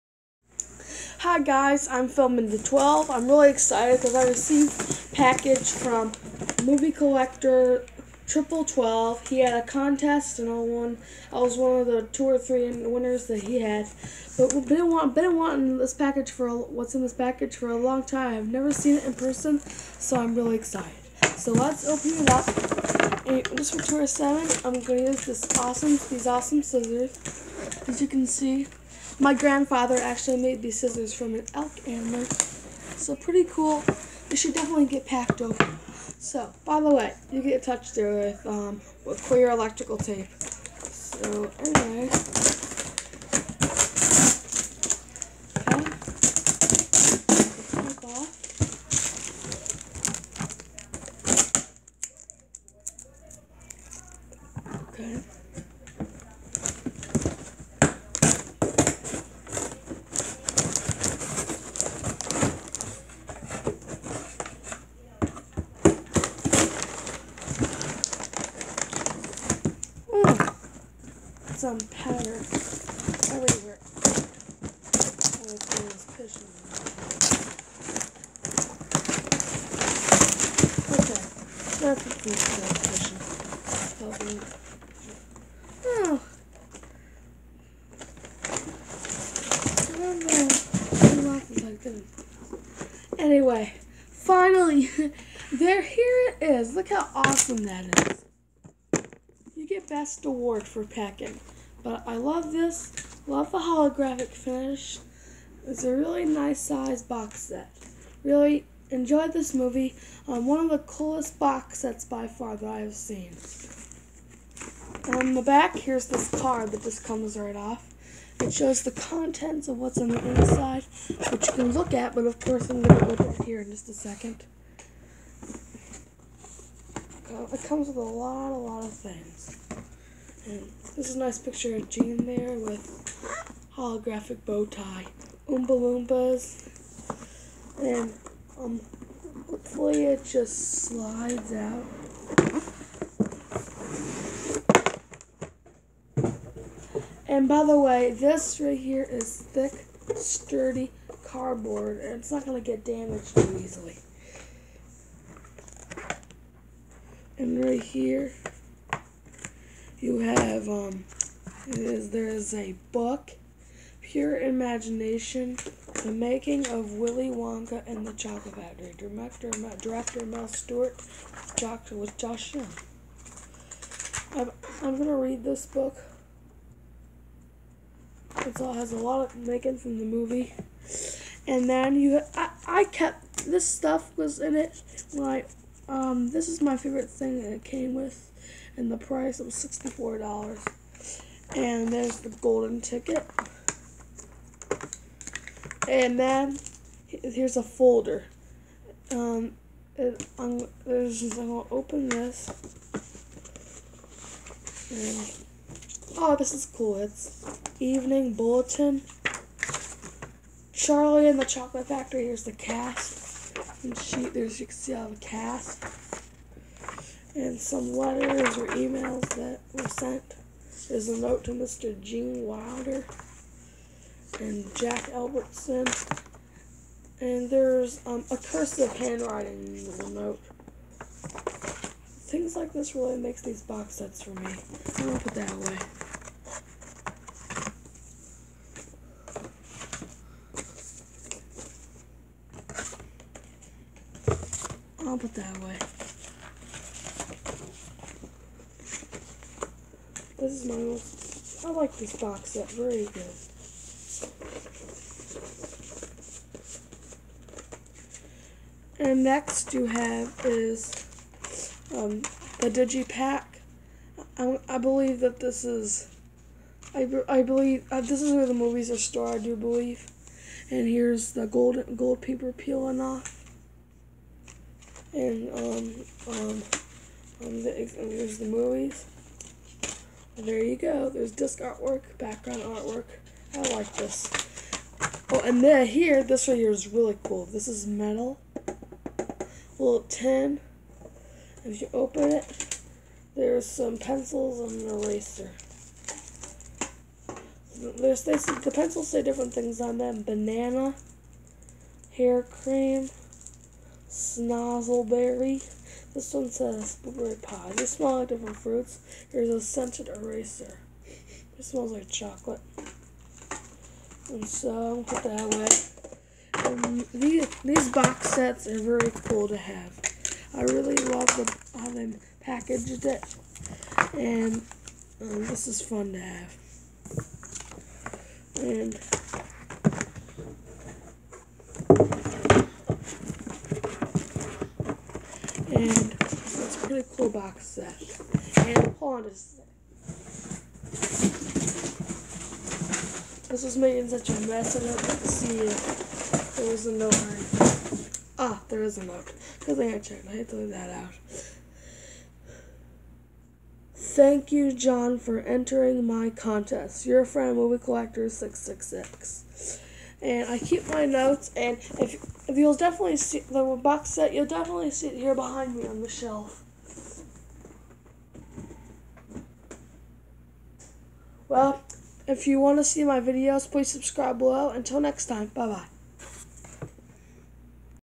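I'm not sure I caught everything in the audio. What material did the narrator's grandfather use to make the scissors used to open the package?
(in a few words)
Elk antler.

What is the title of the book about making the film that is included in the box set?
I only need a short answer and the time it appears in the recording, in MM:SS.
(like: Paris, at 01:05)
Pure Imagination, at 02:44.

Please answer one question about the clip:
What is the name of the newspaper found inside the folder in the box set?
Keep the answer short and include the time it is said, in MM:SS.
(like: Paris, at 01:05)
Evening Bulletin, at 03:27.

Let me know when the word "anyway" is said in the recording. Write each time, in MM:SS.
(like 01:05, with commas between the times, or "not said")
00:41, 01:33.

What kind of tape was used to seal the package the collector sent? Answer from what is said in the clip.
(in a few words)
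Clear electrical tape.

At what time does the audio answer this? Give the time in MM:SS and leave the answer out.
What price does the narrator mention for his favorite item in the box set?
03:09.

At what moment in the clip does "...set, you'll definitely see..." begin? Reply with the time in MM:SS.
06:04.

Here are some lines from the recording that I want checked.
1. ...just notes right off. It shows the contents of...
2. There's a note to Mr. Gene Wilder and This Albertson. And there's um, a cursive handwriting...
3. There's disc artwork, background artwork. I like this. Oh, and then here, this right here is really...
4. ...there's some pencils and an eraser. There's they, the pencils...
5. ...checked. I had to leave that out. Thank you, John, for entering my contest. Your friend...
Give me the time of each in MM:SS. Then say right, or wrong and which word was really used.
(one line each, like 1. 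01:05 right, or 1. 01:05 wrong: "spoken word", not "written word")
1. 01:56 wrong: "comes", not "notes"
2. 03:40 wrong: "Jack", not "This"
3. 04:41 right
4. 04:53 right
5. 05:49 right.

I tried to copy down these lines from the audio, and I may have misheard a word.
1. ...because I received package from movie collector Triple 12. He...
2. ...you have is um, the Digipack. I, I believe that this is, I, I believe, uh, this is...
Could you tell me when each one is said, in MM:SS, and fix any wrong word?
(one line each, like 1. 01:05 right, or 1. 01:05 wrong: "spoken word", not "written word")
1. 00:04 right
2. 04:19 right.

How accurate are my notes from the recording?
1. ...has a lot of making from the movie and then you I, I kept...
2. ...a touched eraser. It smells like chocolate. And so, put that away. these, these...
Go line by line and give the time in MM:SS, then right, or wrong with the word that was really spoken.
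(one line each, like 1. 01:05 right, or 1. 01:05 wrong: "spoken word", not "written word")
1. 02:58 right
2. 05:09 wrong: "scented", not "touched".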